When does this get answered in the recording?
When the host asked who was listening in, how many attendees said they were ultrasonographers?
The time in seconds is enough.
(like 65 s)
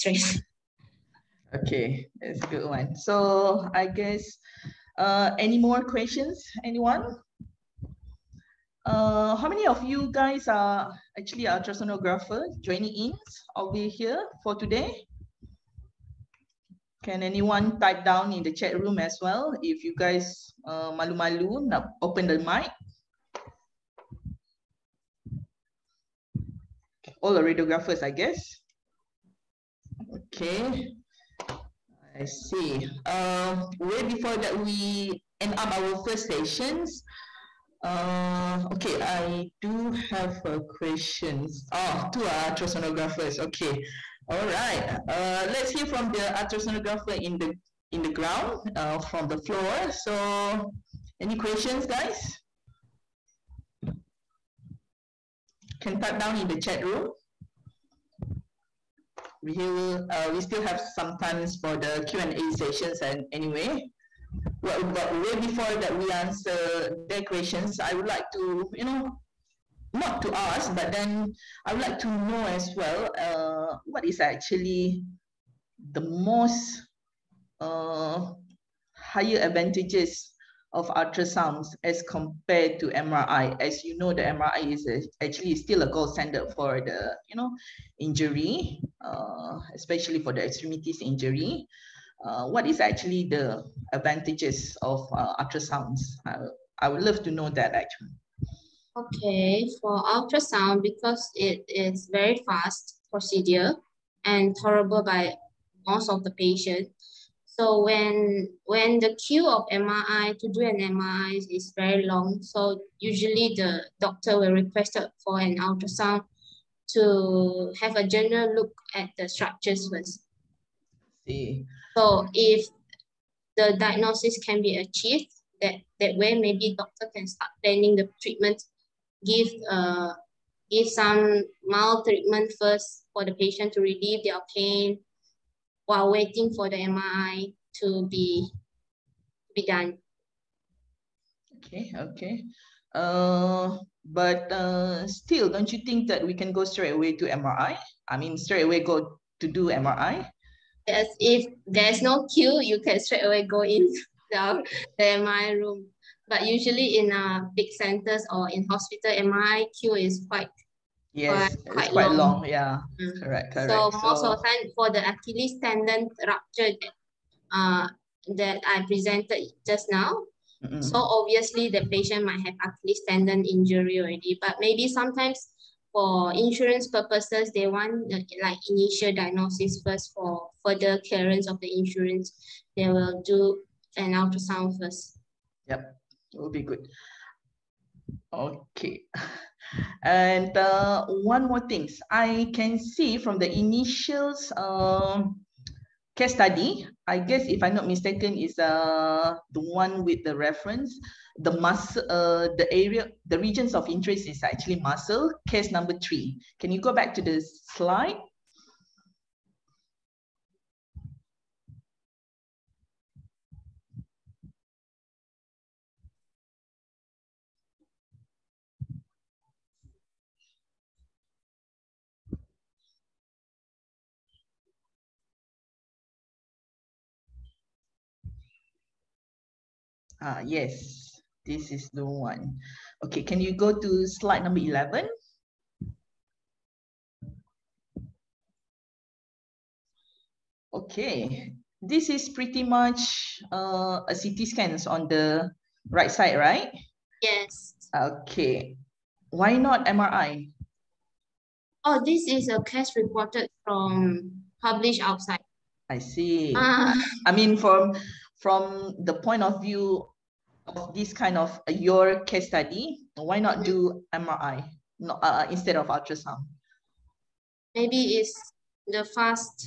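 42 s.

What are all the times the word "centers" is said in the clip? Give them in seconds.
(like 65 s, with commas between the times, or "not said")
157 s.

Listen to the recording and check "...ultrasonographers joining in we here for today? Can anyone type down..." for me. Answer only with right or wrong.
right.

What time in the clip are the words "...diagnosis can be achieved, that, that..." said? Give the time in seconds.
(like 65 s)
123 s.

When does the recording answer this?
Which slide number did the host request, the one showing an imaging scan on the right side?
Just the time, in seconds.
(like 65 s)
234 s.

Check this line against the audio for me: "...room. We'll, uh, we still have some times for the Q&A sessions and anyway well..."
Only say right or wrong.
right.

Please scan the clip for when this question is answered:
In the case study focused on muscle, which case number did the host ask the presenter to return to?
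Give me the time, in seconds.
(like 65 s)
205 s.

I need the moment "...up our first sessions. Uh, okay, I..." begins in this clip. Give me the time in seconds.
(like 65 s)
35 s.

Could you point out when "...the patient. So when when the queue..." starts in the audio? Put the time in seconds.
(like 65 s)
106 s.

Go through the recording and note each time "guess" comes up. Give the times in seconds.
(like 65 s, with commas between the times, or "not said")
3 s, 28 s, 197 s.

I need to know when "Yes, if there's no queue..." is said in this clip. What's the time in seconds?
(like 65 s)
150 s.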